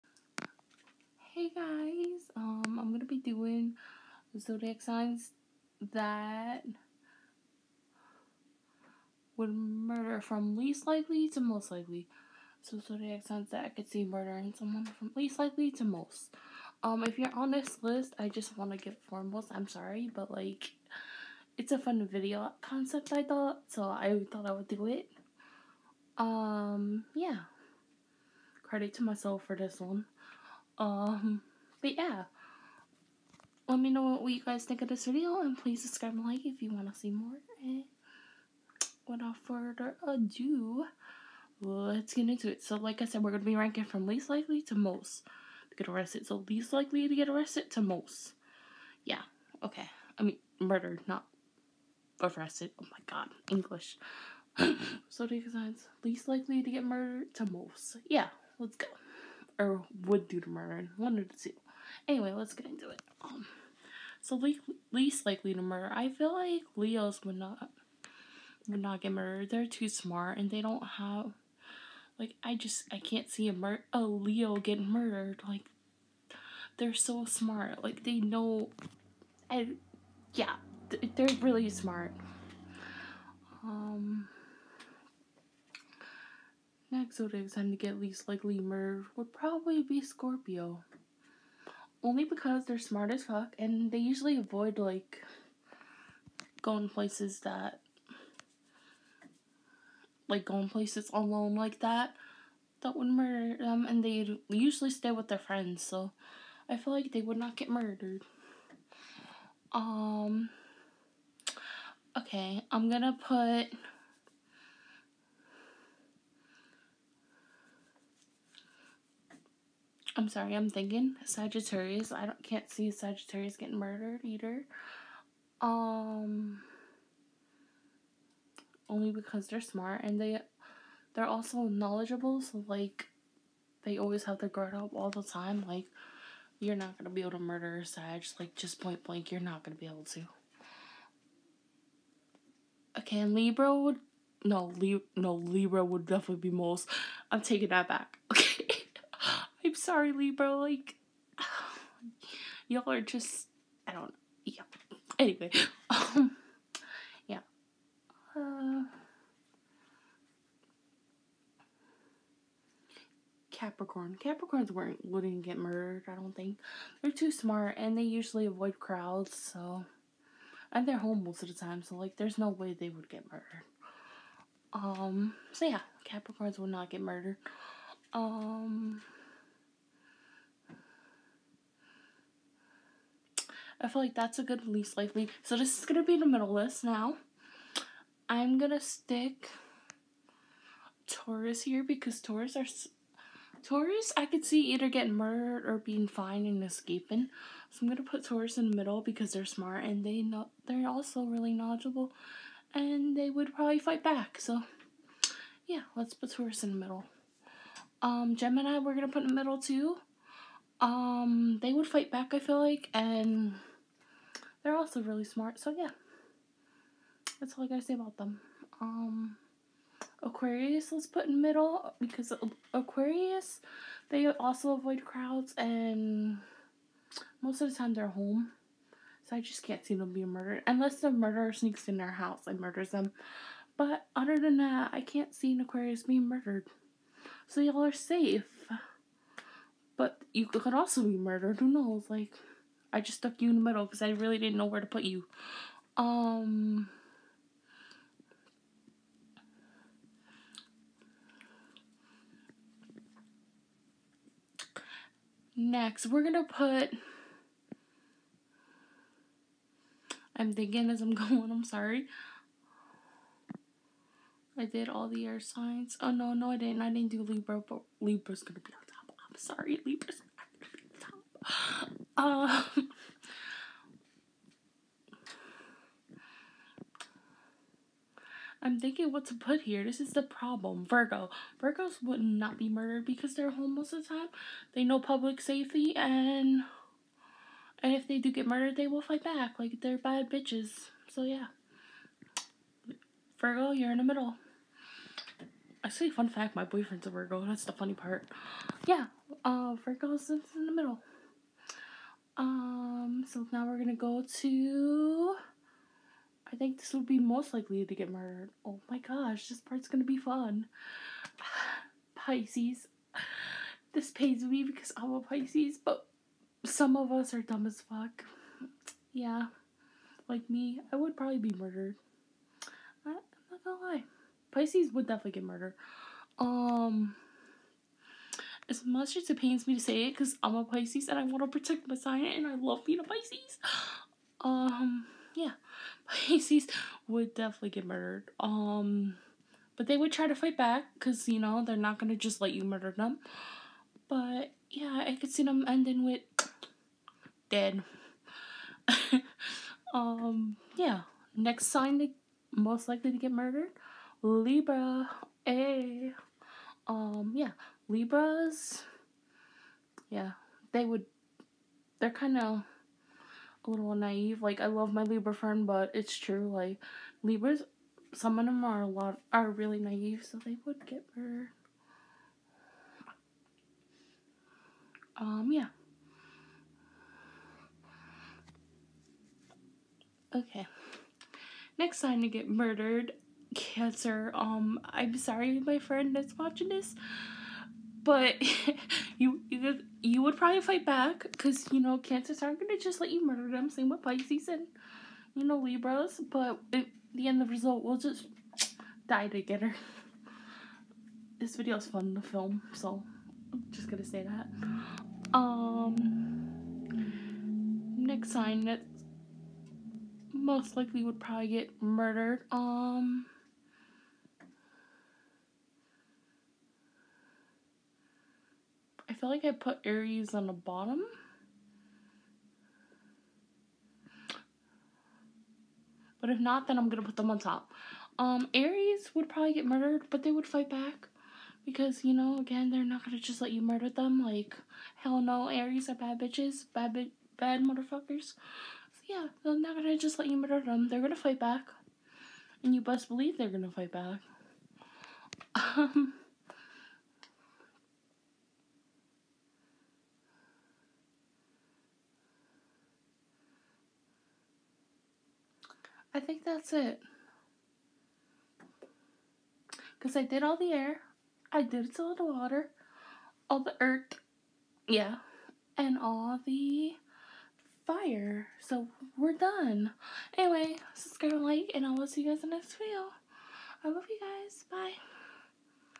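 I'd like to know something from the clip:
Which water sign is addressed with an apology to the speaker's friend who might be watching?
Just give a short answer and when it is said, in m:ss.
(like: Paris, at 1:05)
Cancer, at 6:23.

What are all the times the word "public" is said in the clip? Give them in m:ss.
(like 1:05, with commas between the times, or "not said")
4:44.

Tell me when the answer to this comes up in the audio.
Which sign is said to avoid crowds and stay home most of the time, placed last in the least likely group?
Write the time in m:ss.
2:43.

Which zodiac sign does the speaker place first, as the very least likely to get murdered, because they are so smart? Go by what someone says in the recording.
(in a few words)
Leo.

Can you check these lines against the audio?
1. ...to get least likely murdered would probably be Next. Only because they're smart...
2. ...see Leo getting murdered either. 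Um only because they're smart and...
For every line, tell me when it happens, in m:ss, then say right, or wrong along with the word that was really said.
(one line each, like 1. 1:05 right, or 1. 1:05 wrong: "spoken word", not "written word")
1. 1:27 wrong: "Scorpio", not "Next"
2. 2:02 wrong: "Sagittarius", not "Leo".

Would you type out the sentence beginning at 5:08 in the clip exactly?
Oh my gosh, this part's gonna be fun.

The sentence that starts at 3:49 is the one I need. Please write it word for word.
So I just can't see them being murdered.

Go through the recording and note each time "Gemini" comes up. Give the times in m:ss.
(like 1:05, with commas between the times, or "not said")
3:28.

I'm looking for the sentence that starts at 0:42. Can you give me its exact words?
So, like I said, we're going to be ranking from least likely to most to get arrested.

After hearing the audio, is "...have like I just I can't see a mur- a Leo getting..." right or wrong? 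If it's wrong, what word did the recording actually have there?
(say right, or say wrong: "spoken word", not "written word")
right.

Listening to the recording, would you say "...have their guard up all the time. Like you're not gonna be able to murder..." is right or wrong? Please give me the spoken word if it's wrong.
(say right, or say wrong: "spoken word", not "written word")
right.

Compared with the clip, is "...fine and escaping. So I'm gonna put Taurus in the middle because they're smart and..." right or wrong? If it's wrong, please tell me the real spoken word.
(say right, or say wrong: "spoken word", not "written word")
right.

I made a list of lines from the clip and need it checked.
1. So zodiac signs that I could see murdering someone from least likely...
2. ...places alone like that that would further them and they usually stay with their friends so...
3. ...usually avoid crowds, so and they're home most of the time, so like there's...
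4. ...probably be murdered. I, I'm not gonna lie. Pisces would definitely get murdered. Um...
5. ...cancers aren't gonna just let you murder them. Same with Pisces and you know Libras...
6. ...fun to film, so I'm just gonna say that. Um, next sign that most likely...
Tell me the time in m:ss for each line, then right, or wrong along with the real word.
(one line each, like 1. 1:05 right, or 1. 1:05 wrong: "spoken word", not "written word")
1. 0:12 right
2. 1:40 wrong: "murder", not "further"
3. 2:48 right
4. 5:21 right
5. 6:31 right
6. 6:41 right.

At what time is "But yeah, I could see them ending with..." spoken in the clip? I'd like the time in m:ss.
5:44.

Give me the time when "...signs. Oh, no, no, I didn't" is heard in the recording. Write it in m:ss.
4:25.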